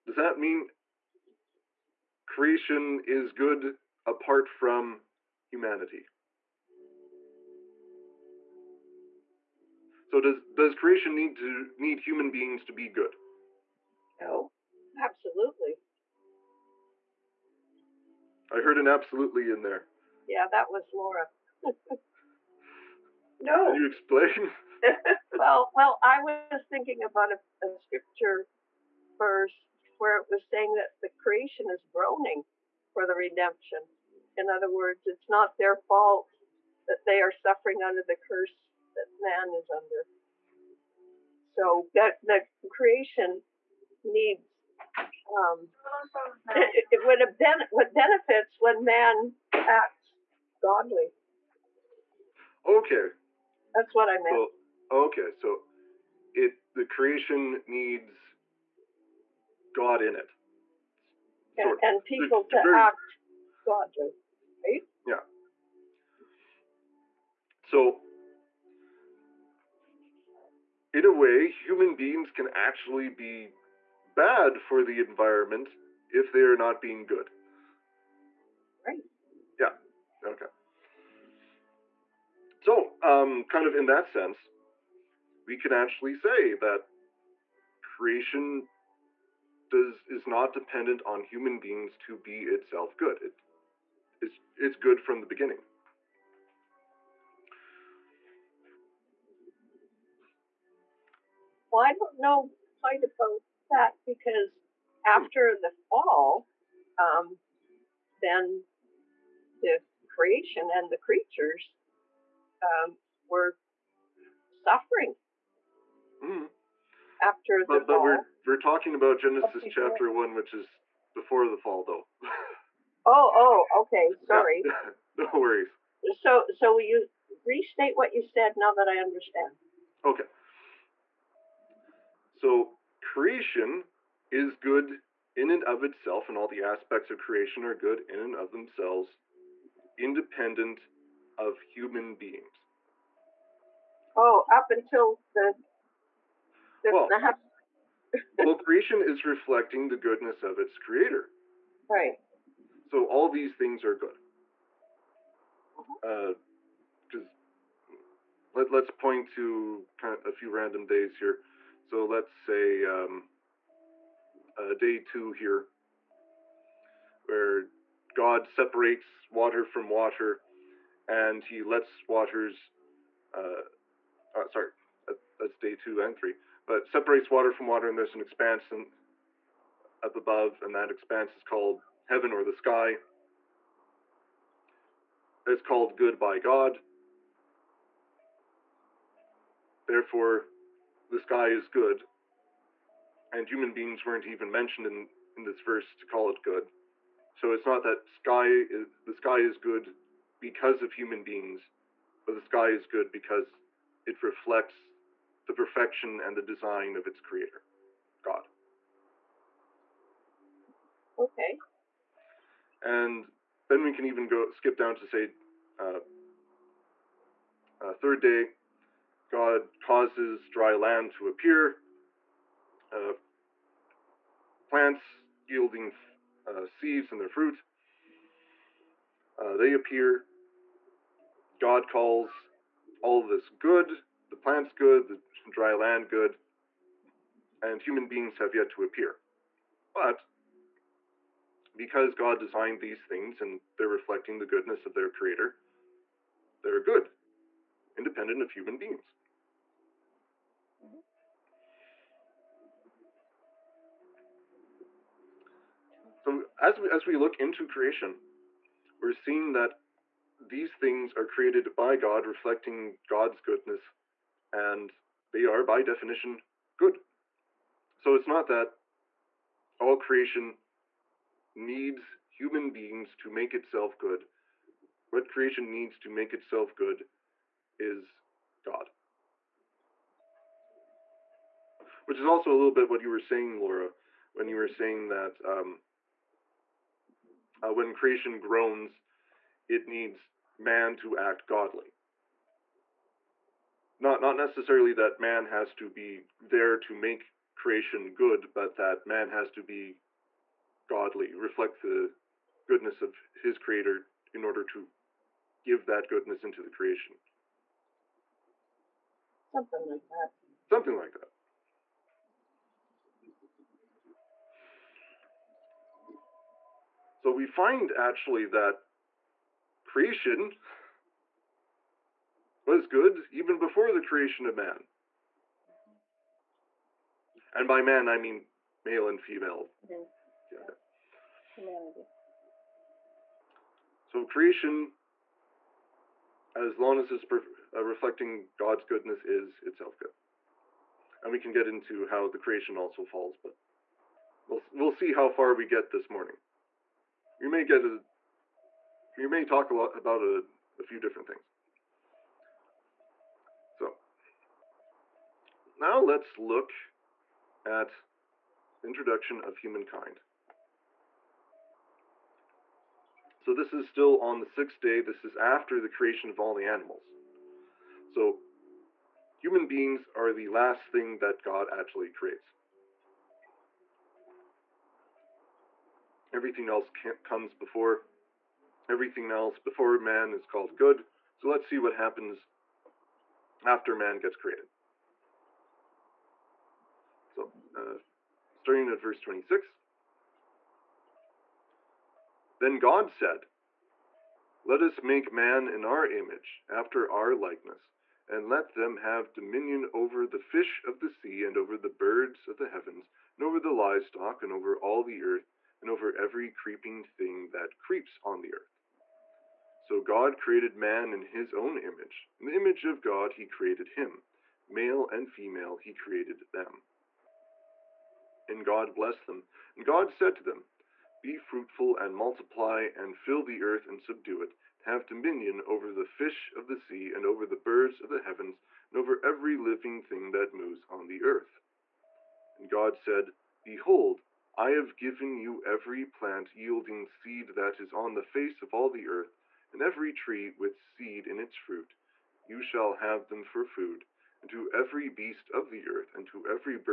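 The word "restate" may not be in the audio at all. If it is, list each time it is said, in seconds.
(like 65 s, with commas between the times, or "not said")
127 s.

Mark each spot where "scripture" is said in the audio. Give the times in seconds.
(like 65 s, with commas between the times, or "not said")
27 s.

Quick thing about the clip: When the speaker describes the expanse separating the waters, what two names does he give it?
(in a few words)
heaven or the sky.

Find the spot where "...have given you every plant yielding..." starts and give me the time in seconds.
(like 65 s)
434 s.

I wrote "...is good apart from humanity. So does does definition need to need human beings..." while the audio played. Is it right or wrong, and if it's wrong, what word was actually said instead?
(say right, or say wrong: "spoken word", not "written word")
wrong: "creation", not "definition".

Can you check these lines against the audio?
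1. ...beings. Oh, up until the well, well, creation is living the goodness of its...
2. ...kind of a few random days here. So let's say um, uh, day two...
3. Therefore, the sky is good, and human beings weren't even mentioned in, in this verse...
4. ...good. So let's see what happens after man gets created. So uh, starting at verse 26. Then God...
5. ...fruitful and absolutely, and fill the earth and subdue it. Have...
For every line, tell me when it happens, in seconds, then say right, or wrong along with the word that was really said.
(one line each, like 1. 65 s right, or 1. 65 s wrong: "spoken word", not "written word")
1. 142 s wrong: "reflecting", not "living"
2. 159 s right
3. 189 s right
4. 380 s right
5. 421 s wrong: "multiply", not "absolutely".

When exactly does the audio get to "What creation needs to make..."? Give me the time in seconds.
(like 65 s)
275 s.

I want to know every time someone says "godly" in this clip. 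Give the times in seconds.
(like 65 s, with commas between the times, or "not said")
50 s, 63 s, 291 s, 300 s.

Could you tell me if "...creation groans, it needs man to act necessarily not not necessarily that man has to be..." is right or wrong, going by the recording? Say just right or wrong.
wrong.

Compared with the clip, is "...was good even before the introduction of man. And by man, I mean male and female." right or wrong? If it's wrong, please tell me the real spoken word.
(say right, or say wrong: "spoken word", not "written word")
wrong: "creation", not "introduction".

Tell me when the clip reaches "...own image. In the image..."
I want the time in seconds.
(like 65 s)
411 s.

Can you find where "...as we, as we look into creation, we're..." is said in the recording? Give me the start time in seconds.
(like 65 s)
256 s.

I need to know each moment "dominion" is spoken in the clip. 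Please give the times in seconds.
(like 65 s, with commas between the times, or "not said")
399 s, 425 s.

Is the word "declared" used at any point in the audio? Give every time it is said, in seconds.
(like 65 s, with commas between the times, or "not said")
not said.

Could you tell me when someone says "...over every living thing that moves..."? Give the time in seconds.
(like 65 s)
428 s.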